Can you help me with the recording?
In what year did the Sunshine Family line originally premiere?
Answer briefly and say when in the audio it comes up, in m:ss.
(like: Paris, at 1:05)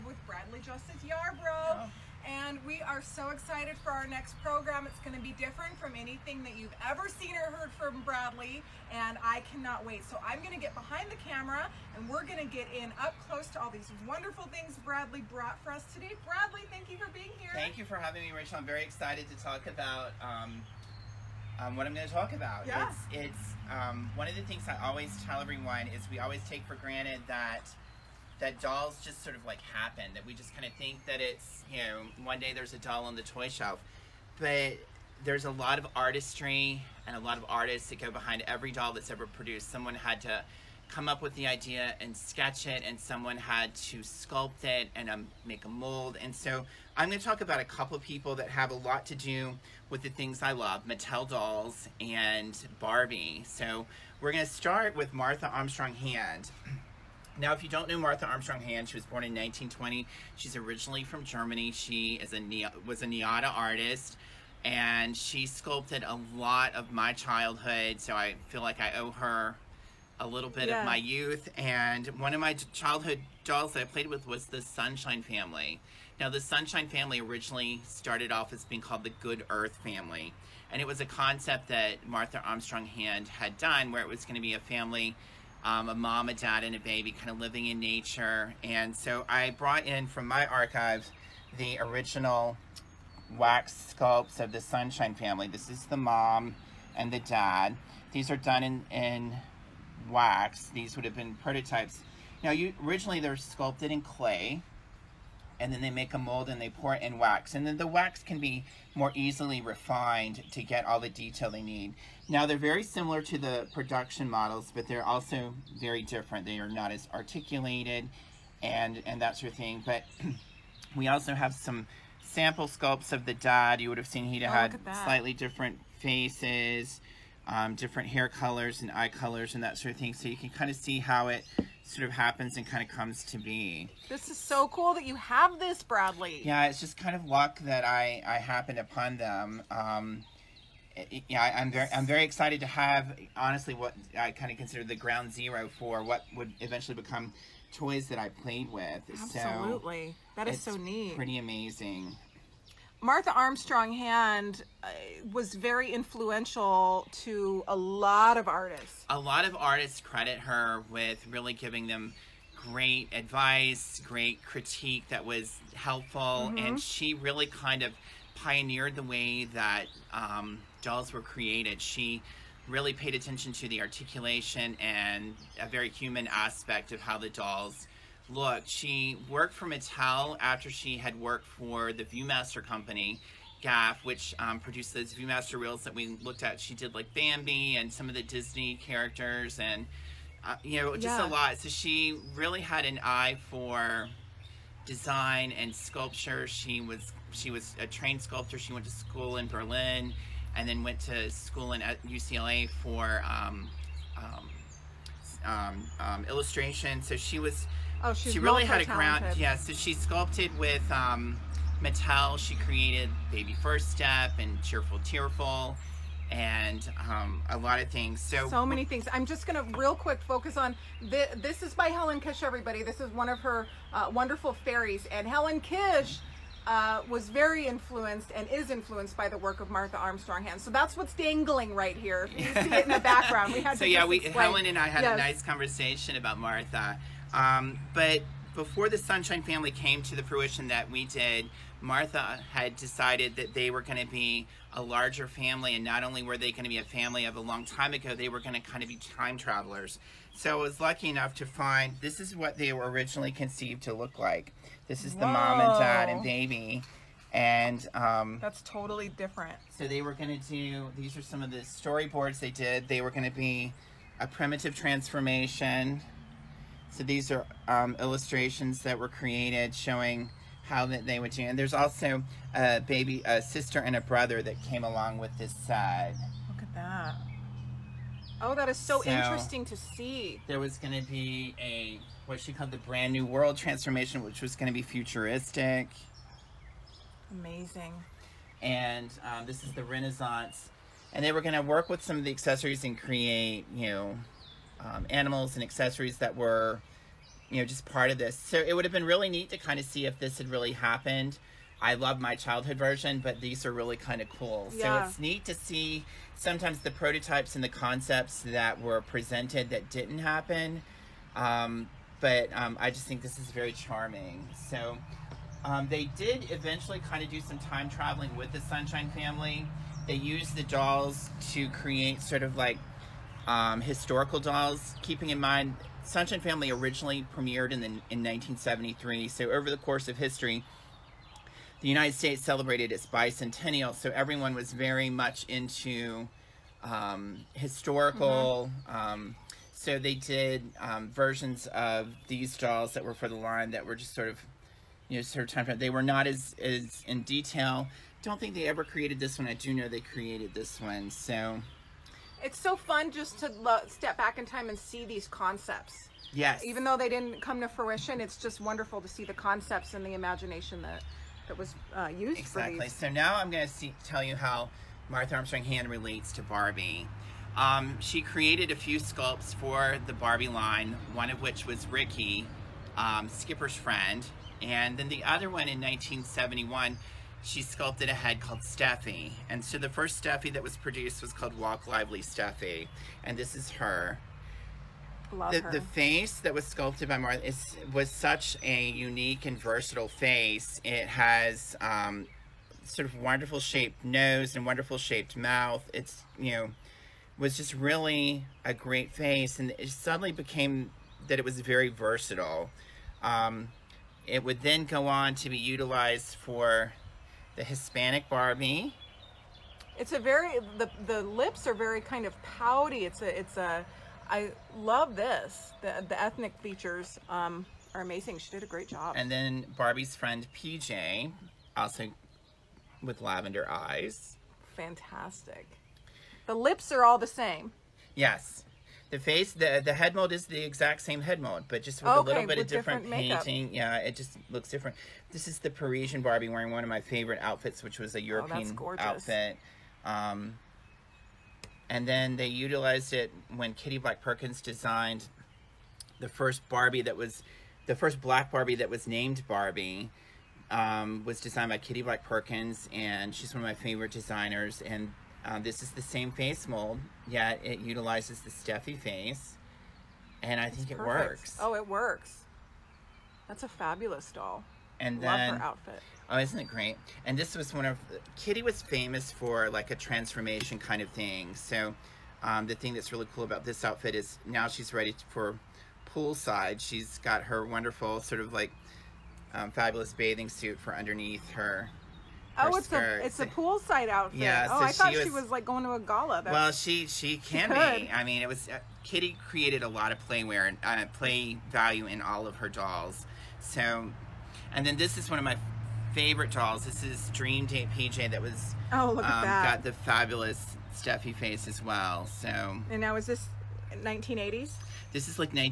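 1973, at 5:28.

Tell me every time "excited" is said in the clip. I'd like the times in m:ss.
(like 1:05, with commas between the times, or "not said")
0:03, 0:18, 2:22.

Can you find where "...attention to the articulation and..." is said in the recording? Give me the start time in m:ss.
2:53.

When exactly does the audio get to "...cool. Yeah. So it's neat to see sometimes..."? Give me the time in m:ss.
5:04.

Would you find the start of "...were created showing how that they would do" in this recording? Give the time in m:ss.
4:28.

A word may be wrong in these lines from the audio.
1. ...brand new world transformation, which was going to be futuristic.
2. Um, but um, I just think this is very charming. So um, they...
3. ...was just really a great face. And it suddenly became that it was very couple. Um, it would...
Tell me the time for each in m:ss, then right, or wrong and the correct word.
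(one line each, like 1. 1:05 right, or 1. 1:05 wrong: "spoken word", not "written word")
1. 4:42 right
2. 5:11 right
3. 6:37 wrong: "versatile", not "couple".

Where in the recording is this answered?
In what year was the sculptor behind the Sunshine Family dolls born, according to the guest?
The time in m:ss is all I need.
0:59.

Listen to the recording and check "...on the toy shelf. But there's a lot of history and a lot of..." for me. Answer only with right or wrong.
wrong.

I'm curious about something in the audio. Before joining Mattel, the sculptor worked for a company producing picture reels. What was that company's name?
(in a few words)
GAF.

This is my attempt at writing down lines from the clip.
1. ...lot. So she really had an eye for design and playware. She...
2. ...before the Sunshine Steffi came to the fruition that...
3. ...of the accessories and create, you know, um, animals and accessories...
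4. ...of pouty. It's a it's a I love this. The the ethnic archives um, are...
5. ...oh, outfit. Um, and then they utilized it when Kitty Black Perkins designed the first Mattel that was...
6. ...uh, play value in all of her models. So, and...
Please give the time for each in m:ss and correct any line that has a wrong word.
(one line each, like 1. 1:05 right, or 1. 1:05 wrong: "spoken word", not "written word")
1. 3:11 wrong: "sculpture", not "playware"
2. 3:58 wrong: "Family", not "Steffi"
3. 4:52 right
4. 6:52 wrong: "features", not "archives"
5. 7:18 wrong: "Barbie", not "Mattel"
6. 8:10 wrong: "dolls", not "models".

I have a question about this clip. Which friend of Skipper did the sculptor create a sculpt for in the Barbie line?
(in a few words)
Ricky.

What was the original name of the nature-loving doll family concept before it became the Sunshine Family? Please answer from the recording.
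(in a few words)
Good Earth Family.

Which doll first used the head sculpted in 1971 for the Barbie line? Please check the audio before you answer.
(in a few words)
Walk Lively Steffi.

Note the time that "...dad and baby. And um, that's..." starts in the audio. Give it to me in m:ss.
4:15.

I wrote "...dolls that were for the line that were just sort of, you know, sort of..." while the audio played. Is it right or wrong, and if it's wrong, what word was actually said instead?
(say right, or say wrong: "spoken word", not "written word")
right.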